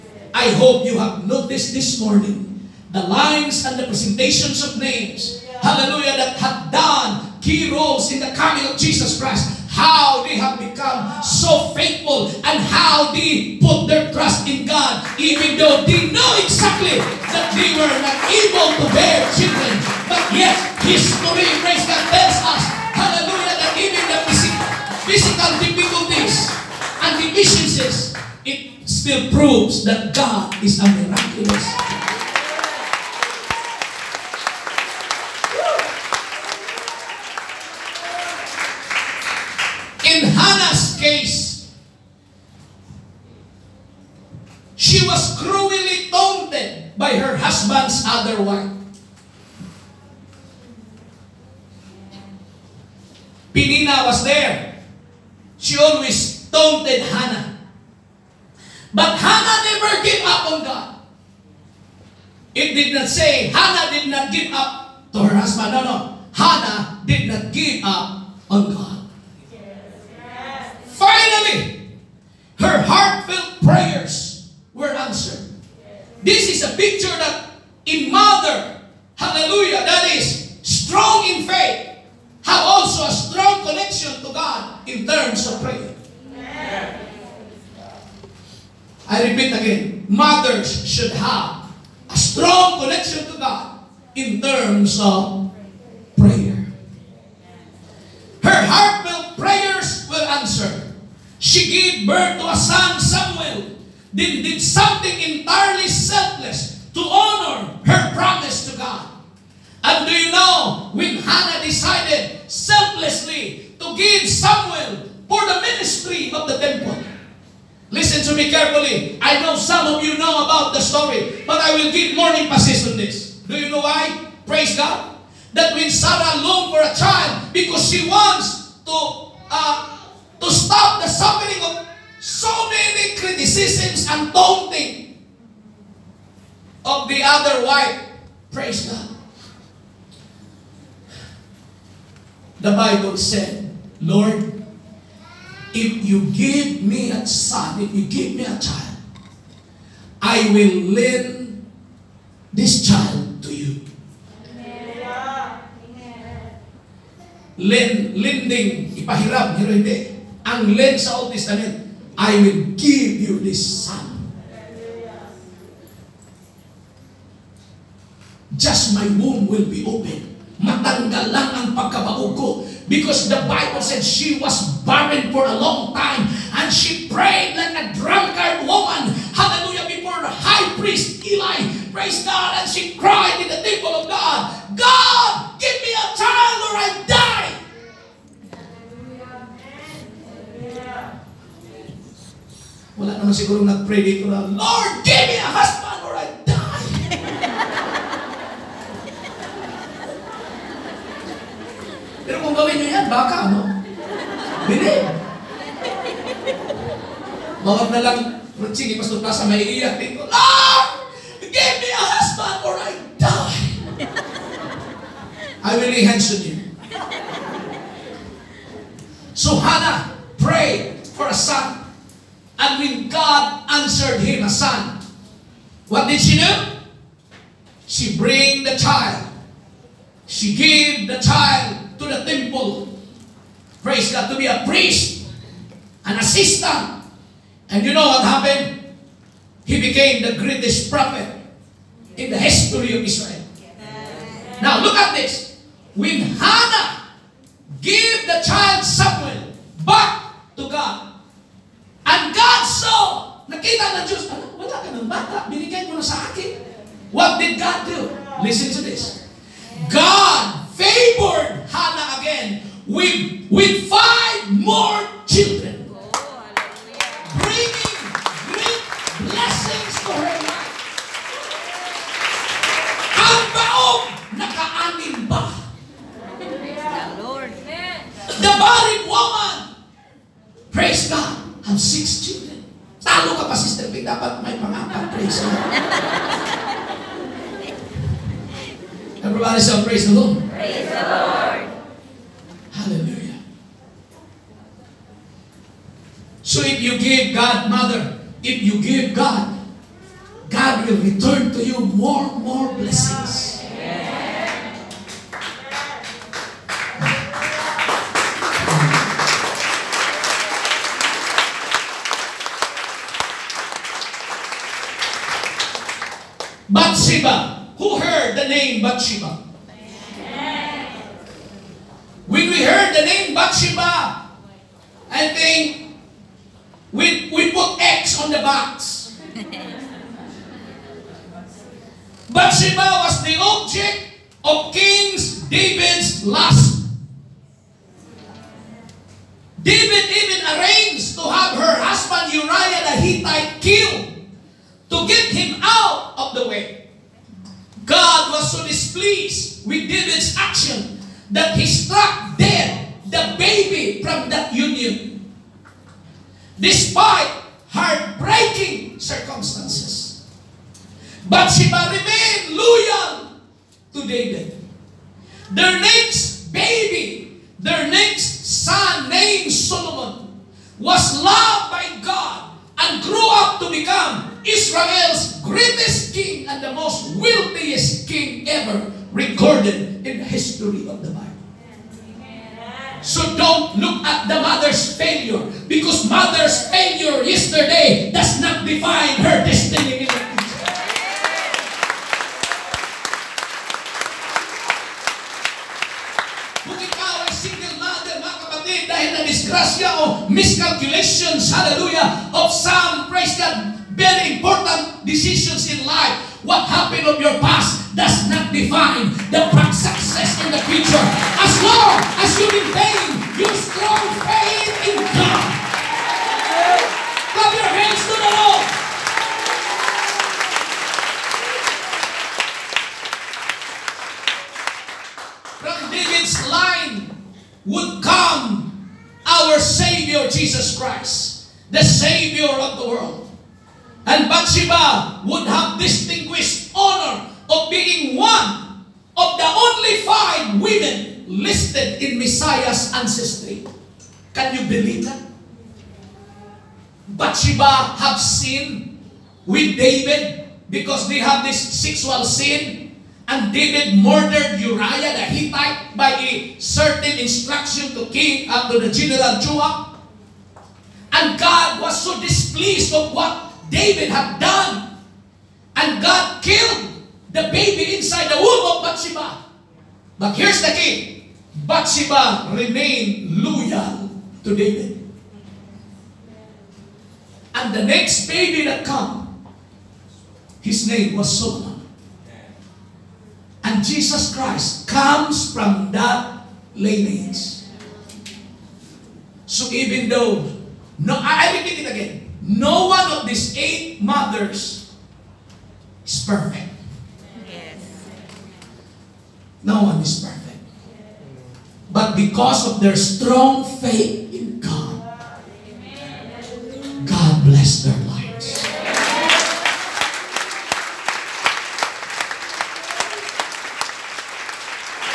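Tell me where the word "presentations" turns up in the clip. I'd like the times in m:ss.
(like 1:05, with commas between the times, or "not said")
0:03.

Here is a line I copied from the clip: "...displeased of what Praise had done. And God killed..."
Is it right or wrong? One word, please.
wrong.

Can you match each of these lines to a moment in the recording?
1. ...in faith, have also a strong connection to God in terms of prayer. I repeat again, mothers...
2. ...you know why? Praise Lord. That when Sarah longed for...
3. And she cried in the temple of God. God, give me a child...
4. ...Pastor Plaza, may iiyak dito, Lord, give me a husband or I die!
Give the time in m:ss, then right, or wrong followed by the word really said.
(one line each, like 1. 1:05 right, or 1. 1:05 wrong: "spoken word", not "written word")
1. 1:21 right
2. 2:03 wrong: "God", not "Lord"
3. 3:02 right
4. 3:28 right.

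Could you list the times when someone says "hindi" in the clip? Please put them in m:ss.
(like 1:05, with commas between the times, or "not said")
2:39, 3:24.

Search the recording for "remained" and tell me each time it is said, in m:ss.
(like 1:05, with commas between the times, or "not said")
6:01, 7:52.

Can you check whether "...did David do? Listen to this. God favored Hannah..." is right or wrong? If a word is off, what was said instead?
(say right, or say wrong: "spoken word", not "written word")
wrong: "God", not "David".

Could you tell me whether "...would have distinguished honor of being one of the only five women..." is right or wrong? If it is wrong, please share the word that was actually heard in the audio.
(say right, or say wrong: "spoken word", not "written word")
right.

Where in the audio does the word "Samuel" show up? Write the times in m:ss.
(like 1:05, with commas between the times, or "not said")
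1:54, 4:08.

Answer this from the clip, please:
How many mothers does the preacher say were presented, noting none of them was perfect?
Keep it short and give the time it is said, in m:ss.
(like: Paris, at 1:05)
8, at 8:13.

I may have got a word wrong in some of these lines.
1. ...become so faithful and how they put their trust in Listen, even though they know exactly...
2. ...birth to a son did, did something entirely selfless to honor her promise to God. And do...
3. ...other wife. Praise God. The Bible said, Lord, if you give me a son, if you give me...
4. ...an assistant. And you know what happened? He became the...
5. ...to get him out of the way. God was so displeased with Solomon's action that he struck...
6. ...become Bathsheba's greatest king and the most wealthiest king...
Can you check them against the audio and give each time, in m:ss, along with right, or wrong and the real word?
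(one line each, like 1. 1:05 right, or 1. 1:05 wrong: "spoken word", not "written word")
1. 0:10 wrong: "God", not "Listen"
2. 1:42 right
3. 2:17 right
4. 3:56 right
5. 5:44 wrong: "David", not "Solomon"
6. 6:13 wrong: "Israel", not "Bathsheba".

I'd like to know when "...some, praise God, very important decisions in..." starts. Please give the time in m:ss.
6:42.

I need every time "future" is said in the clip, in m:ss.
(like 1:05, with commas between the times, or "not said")
6:30, 6:50.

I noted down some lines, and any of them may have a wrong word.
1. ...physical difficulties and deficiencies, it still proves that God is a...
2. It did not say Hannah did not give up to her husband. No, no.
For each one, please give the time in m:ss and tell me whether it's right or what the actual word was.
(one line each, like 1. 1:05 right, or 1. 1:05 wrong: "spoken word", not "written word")
1. 0:25 right
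2. 1:02 right.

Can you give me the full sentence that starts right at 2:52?
Because the Bible said she was barren for a long time.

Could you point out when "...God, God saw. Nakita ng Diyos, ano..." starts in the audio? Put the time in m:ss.
4:10.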